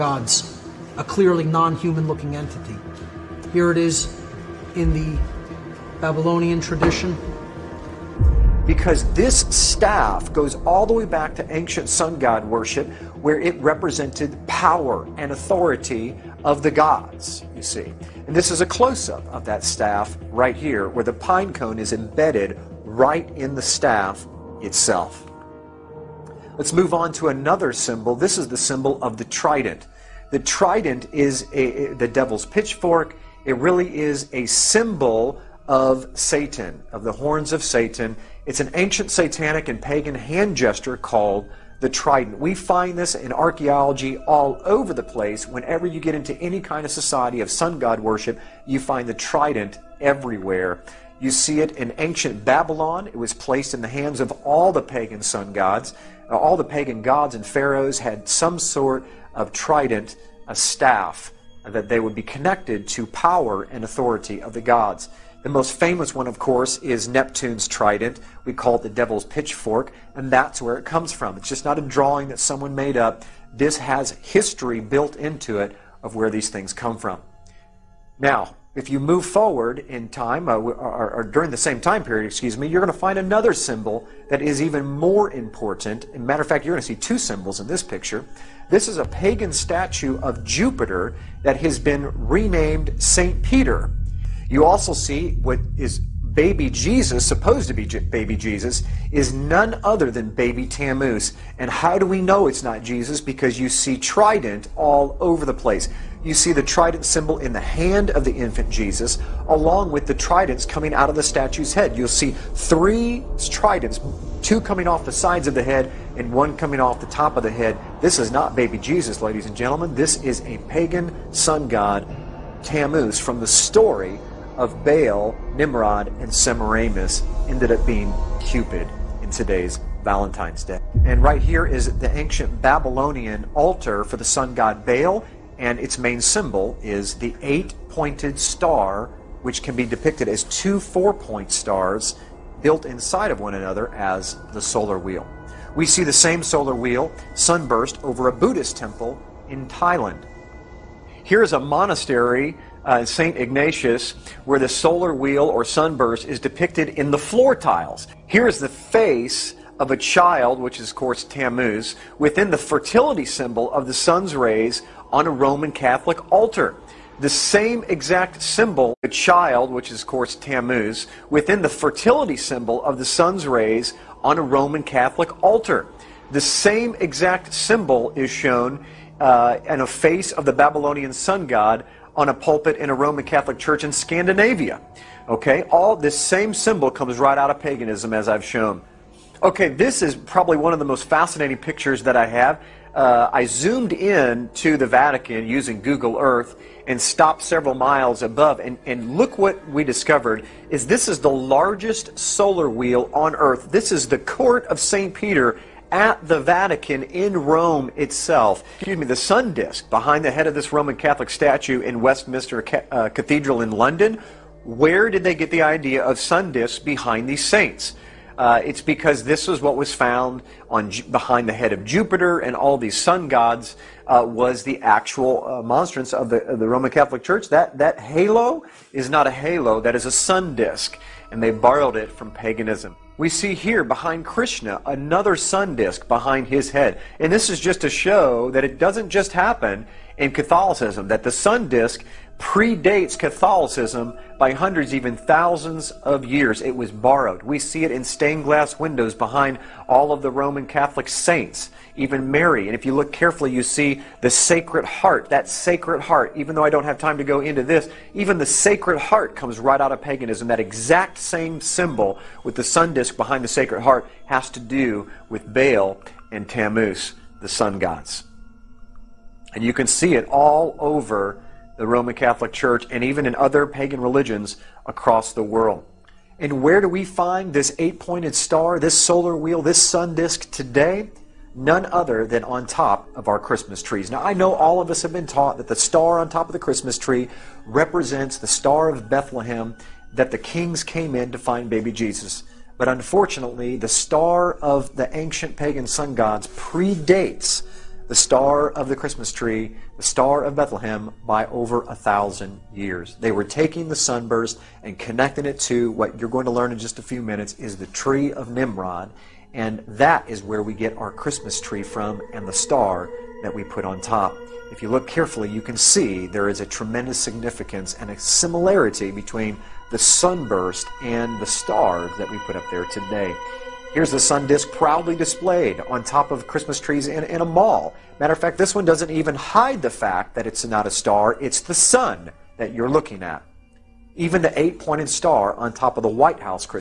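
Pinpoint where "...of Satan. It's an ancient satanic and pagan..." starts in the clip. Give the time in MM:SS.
00:37.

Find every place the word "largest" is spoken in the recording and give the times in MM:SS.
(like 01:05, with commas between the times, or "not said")
03:21.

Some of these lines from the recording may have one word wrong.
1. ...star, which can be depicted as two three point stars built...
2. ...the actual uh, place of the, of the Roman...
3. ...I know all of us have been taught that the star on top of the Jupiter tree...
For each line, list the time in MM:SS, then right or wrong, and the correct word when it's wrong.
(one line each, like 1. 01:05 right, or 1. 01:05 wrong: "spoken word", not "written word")
1. 02:18 wrong: "four", not "three"
2. 03:44 wrong: "monstrance", not "place"
3. 04:44 wrong: "Christmas", not "Jupiter".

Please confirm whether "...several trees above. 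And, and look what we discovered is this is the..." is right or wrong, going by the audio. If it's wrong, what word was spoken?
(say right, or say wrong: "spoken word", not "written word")
wrong: "miles", not "trees".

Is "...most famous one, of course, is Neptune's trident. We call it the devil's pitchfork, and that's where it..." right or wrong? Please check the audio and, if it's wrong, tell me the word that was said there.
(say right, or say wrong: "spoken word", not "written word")
right.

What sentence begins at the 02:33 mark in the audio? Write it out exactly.
Ignatius, where the solar wheel or sunburst is depicted in the floor tiles.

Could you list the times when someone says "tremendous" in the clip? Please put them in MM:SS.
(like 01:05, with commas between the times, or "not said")
05:16.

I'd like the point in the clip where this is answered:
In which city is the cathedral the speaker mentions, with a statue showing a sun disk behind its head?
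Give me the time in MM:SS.
03:33.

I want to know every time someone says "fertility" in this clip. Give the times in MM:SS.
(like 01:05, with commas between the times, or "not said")
02:42, 02:51.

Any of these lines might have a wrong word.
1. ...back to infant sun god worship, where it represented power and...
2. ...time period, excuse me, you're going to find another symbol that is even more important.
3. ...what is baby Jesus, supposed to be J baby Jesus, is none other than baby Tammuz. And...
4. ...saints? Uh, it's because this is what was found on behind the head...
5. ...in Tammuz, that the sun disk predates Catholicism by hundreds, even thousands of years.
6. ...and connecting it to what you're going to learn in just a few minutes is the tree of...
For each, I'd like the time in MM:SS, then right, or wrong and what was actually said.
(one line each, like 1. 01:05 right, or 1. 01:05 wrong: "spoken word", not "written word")
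1. 00:11 wrong: "ancient", not "infant"
2. 01:21 right
3. 01:35 right
4. 03:37 right
5. 04:00 wrong: "Catholicism", not "Tammuz"
6. 05:04 right.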